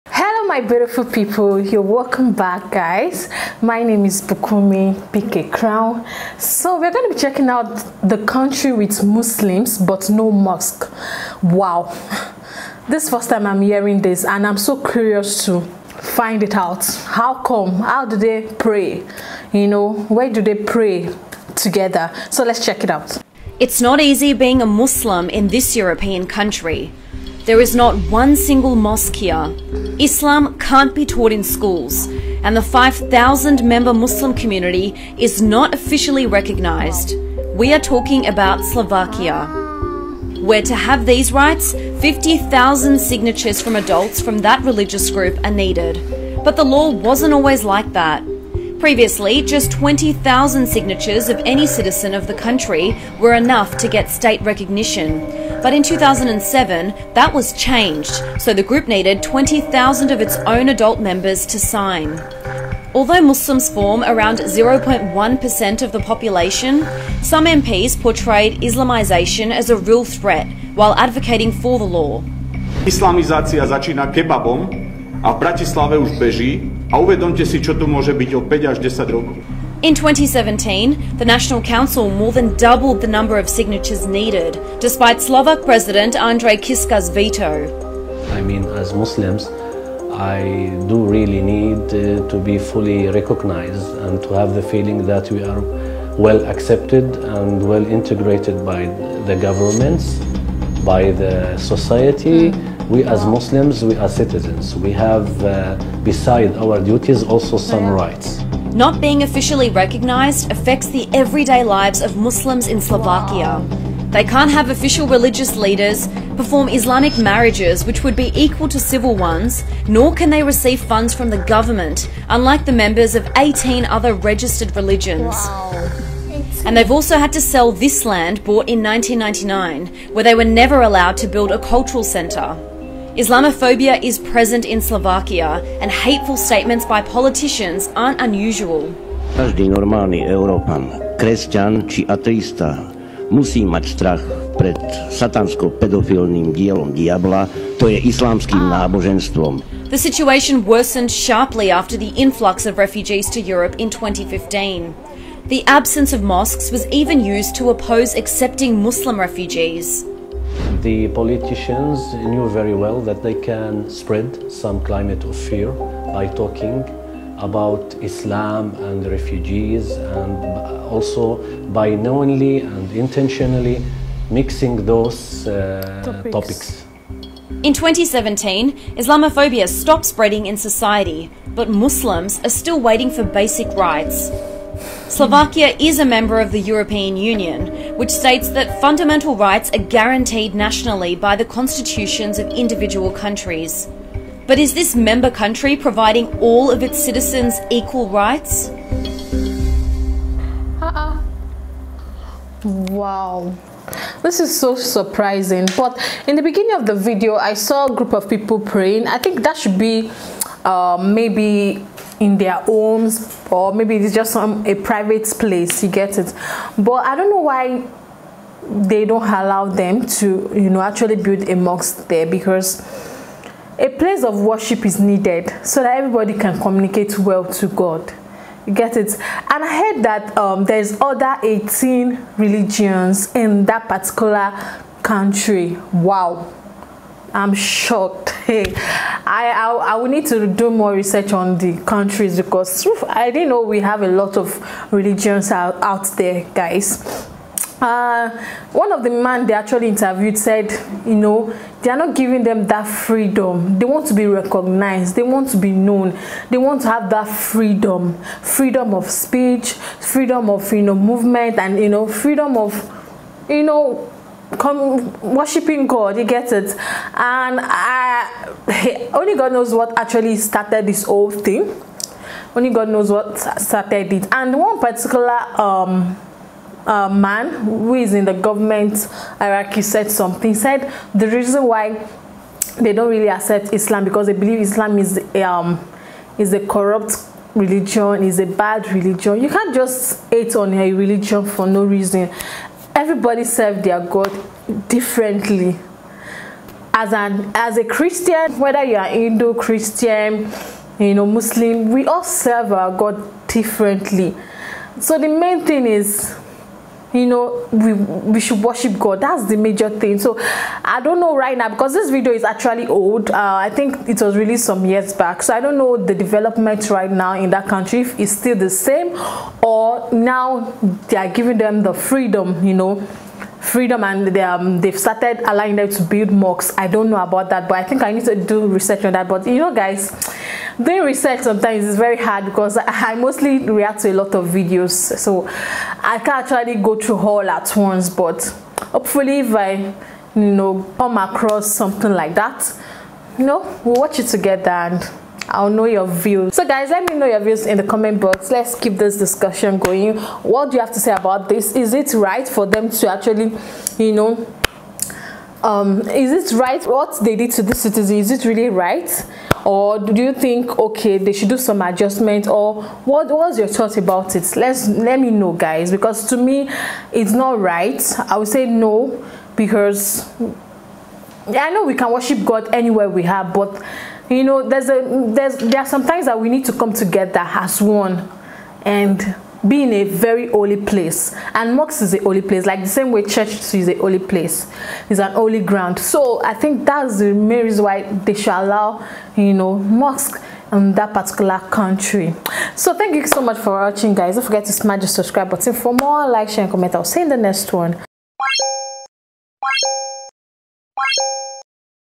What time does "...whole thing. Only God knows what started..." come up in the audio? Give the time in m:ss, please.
4:31.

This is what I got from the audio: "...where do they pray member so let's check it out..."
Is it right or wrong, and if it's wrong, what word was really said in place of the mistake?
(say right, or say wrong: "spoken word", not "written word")
wrong: "together", not "member".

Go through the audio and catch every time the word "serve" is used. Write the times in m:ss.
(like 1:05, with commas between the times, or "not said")
4:53, 5:02.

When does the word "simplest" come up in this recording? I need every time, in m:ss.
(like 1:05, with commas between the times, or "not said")
not said.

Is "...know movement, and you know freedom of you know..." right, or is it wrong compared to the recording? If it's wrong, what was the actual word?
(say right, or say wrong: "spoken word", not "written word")
right.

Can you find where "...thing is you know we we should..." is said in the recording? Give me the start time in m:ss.
5:05.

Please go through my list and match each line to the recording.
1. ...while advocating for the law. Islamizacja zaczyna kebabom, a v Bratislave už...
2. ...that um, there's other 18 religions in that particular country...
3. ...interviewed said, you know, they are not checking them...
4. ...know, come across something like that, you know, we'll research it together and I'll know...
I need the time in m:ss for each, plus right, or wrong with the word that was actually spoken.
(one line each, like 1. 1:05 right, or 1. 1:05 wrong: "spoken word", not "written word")
1. 1:10 right
2. 3:50 right
3. 4:09 wrong: "giving", not "checking"
4. 5:40 wrong: "watch", not "research".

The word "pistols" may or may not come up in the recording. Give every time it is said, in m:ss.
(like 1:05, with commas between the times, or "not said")
not said.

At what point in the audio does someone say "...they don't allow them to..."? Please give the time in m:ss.
3:38.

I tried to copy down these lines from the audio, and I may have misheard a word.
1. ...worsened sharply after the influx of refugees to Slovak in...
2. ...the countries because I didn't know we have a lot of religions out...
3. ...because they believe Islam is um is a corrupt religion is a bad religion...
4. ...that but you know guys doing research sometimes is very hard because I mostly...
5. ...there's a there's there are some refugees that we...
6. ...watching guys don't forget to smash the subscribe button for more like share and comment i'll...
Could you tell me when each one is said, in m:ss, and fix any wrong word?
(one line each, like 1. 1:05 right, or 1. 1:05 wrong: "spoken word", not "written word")
1. 2:30 wrong: "Europe", not "Slovak"
2. 4:01 right
3. 4:44 right
4. 5:29 right
5. 6:14 wrong: "times", not "refugees"
6. 6:33 right.